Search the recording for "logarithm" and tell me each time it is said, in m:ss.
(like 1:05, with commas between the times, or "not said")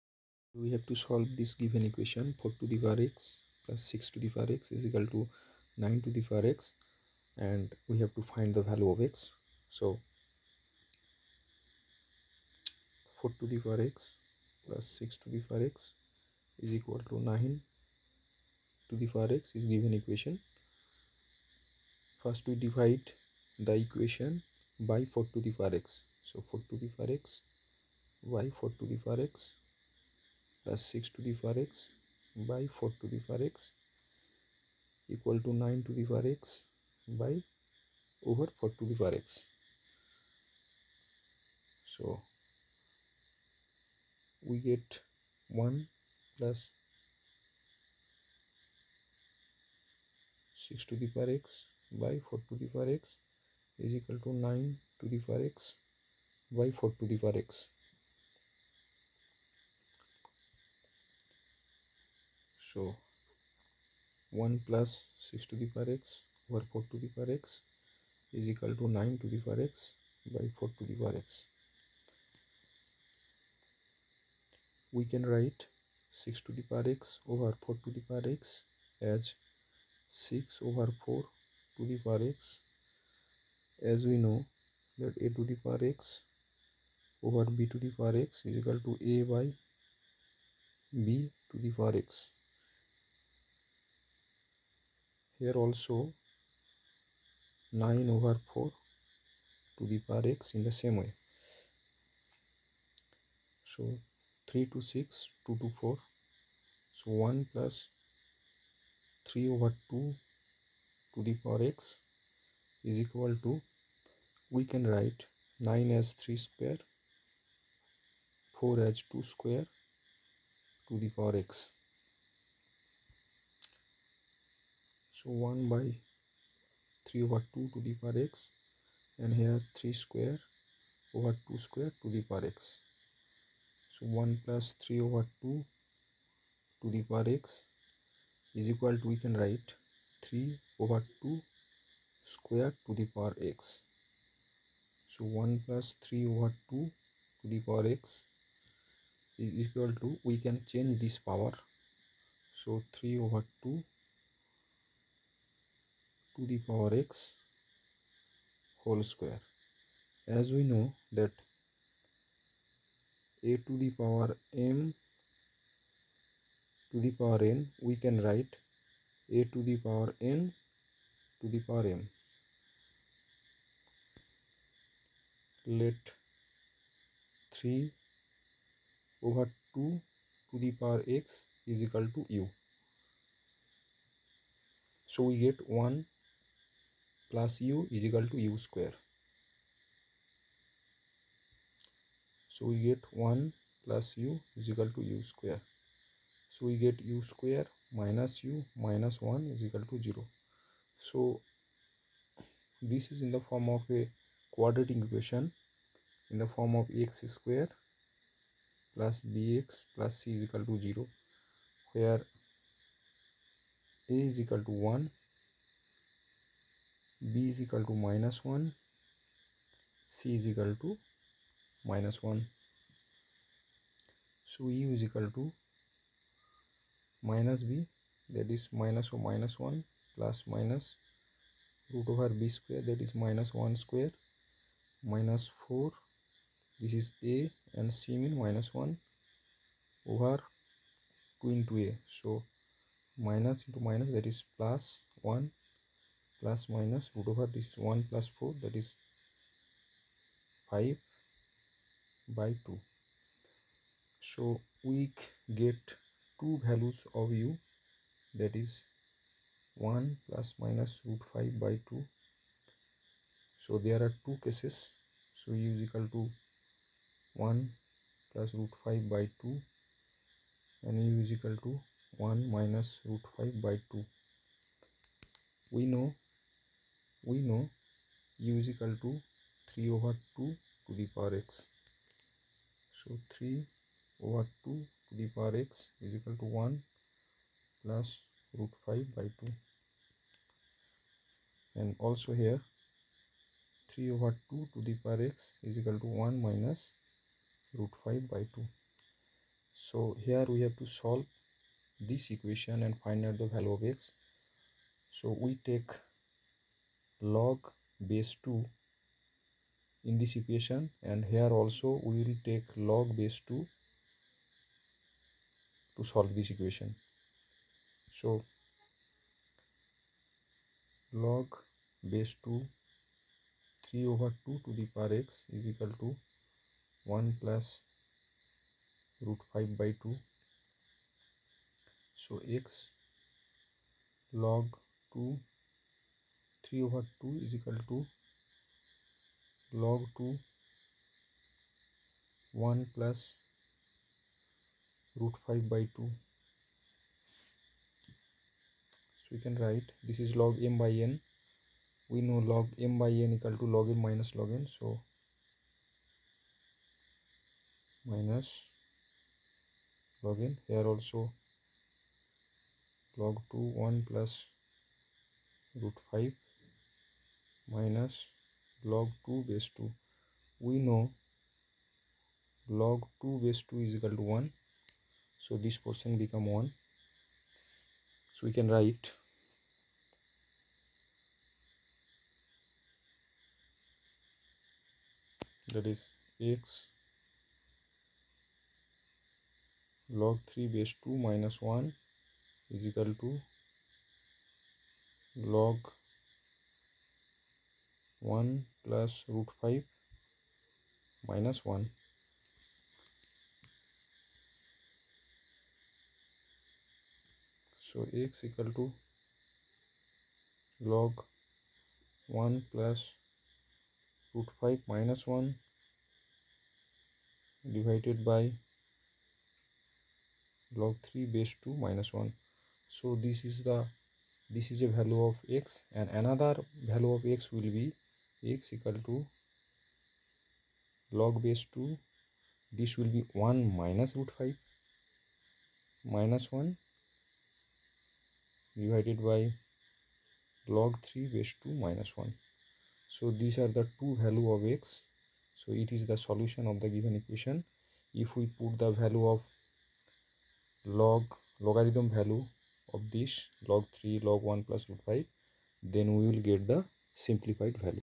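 7:31.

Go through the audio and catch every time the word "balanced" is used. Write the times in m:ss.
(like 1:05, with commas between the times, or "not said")
not said.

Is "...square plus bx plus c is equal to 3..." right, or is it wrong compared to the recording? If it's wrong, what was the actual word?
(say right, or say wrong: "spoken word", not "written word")
wrong: "0", not "3".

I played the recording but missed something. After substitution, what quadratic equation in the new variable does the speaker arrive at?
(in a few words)
u² − u − 1 = 0.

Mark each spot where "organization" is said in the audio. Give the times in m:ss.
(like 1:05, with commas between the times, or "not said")
not said.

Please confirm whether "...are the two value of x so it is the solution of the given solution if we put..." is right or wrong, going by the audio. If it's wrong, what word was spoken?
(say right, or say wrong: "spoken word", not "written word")
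wrong: "equation", not "solution".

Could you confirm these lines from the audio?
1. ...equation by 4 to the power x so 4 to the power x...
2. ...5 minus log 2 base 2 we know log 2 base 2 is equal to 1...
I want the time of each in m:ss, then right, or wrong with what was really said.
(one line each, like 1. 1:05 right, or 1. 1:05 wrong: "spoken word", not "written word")
1. 0:23 right
2. 6:06 right.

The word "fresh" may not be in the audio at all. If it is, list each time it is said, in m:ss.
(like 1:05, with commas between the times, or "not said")
not said.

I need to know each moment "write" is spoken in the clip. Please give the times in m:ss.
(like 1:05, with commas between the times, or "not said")
1:15, 1:54, 2:19, 2:48, 5:49, 6:18.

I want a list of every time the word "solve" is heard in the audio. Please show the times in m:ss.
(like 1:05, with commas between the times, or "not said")
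0:00, 5:00, 5:16.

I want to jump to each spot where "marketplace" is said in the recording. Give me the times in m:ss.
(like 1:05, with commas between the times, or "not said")
not said.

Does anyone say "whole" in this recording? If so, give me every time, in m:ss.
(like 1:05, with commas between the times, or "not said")
2:38.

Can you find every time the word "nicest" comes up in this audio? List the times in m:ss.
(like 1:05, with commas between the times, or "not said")
not said.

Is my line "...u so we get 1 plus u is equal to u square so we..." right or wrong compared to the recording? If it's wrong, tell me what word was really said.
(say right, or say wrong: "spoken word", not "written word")
right.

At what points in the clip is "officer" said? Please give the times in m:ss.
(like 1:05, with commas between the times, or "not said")
not said.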